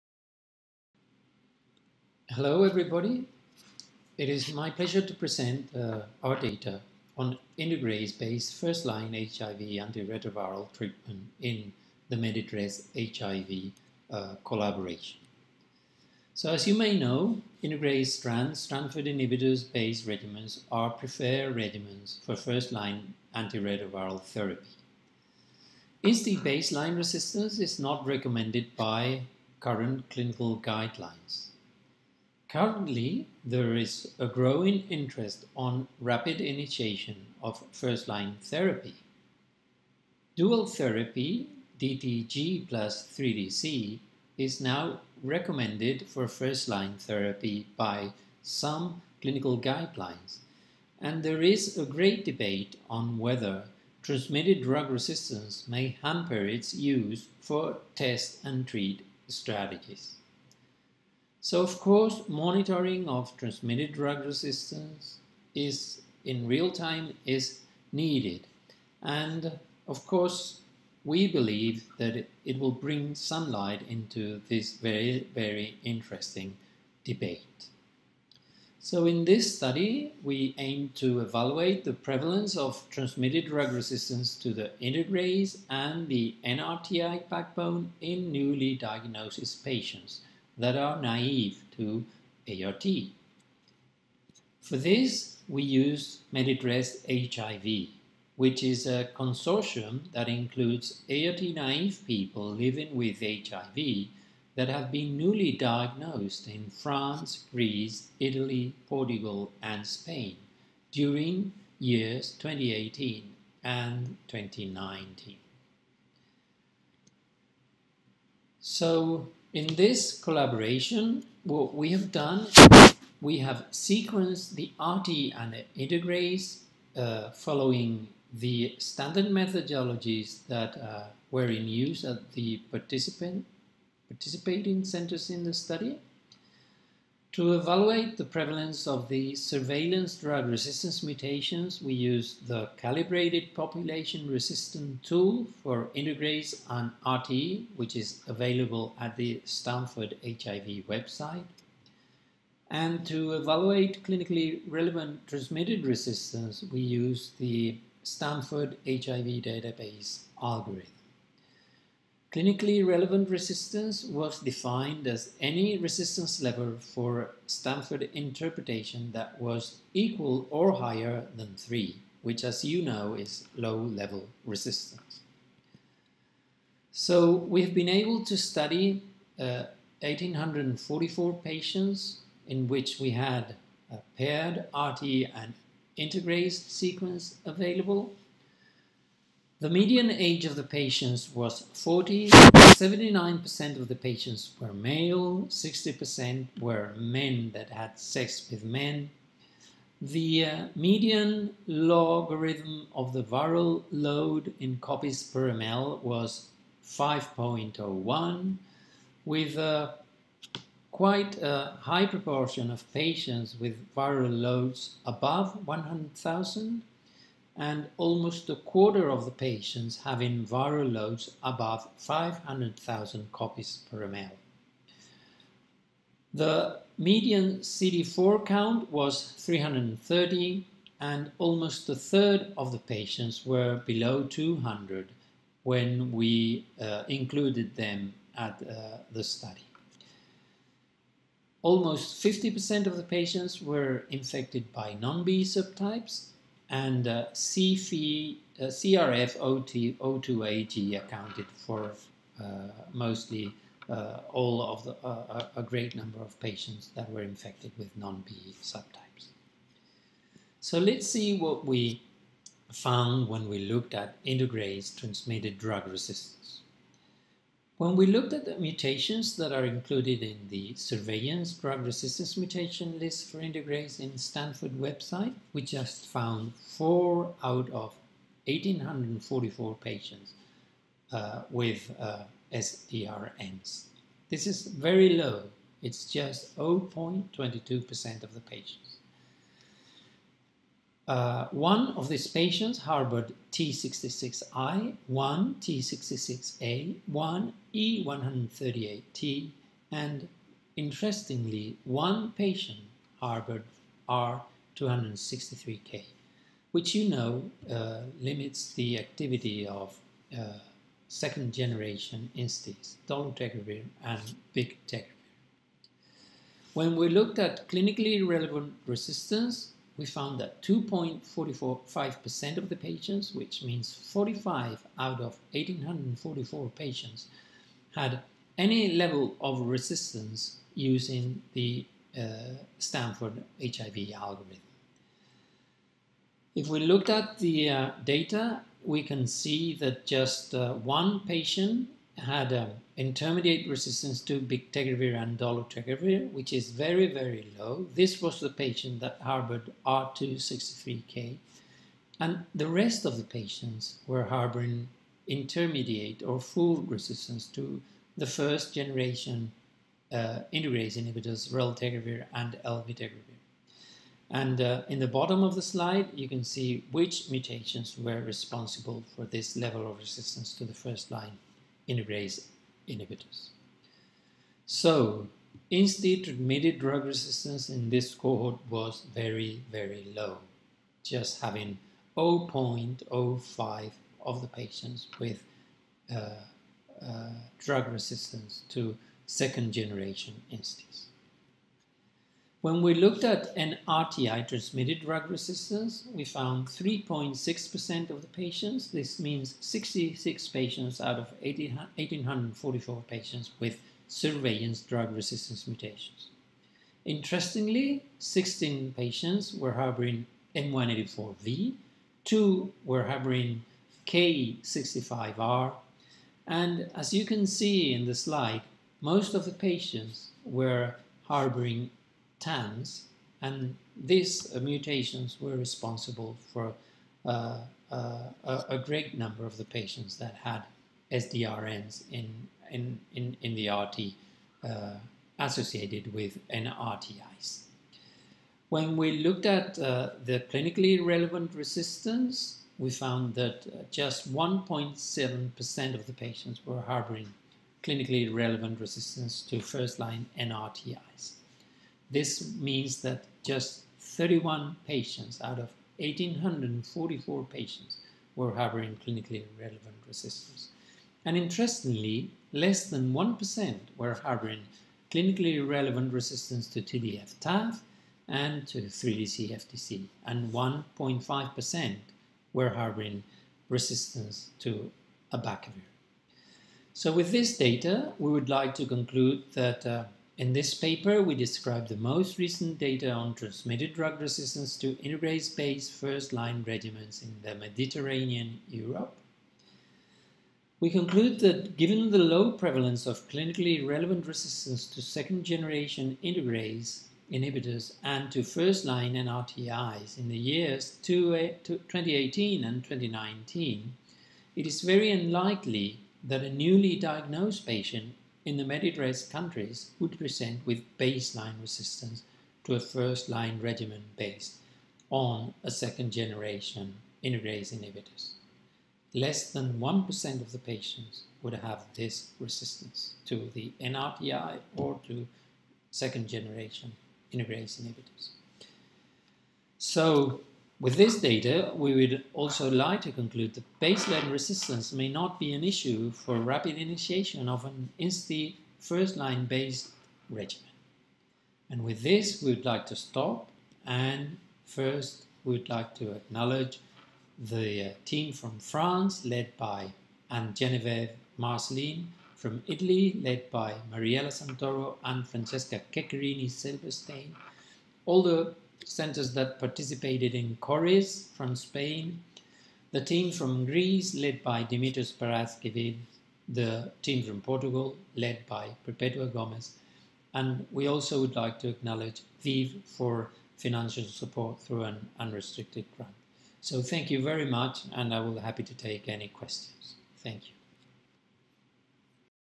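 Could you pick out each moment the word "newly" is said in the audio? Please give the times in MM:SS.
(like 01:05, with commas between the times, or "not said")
01:28, 01:45, 08:26.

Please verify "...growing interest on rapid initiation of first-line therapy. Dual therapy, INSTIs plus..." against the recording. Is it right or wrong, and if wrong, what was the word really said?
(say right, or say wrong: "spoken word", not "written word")
wrong: "DTG", not "INSTIs".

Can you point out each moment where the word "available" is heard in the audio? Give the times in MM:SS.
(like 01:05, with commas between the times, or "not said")
02:28, 03:07.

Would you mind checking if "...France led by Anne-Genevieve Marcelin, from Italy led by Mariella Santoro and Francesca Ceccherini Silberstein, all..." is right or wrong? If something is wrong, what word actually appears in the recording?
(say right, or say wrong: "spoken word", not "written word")
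right.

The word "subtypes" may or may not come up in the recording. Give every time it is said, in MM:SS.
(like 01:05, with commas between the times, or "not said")
04:05, 04:18.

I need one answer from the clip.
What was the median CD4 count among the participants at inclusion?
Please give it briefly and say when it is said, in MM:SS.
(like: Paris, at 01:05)
330, at 03:49.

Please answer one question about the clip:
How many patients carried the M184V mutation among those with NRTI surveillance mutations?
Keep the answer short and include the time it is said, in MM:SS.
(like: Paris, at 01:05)
16, at 06:48.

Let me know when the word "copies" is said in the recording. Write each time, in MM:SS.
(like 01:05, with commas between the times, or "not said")
03:24, 03:43.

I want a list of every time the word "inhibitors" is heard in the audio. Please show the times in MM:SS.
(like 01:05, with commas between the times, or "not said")
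00:19, 06:00, 06:12, 08:17, 08:37, 08:47.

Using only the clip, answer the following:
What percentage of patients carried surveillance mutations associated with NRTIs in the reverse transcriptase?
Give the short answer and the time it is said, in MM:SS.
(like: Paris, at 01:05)
3.6%, at 06:36.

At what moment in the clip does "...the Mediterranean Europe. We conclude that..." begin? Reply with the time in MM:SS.
08:07.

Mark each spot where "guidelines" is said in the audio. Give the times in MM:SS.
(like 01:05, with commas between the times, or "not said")
00:30, 00:49.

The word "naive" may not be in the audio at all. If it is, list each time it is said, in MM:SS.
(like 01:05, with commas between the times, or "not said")
01:31, 01:41.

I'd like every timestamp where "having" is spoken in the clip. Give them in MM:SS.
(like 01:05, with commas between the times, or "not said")
03:40, 06:21.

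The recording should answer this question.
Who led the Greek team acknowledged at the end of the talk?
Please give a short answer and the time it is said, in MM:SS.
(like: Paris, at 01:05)
Dimitris Paraskevis, at 09:24.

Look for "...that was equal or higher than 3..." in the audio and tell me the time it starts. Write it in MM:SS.
02:49.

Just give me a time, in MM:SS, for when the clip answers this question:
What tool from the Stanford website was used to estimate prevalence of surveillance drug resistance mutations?
02:22.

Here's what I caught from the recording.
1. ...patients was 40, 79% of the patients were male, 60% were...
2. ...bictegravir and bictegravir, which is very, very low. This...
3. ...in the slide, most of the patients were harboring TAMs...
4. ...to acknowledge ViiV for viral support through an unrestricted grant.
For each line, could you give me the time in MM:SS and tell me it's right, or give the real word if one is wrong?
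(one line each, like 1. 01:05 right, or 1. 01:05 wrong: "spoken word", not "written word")
1. 03:10 right
2. 05:44 wrong: "dolutegravir", not "bictegravir"
3. 06:57 right
4. 09:31 wrong: "financial", not "viral".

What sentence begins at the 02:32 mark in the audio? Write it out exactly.
And to evaluate clinically relevant transmitted resistance, we use the Stanford HIV database algorithm.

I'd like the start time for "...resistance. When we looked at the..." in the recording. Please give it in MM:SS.
04:25.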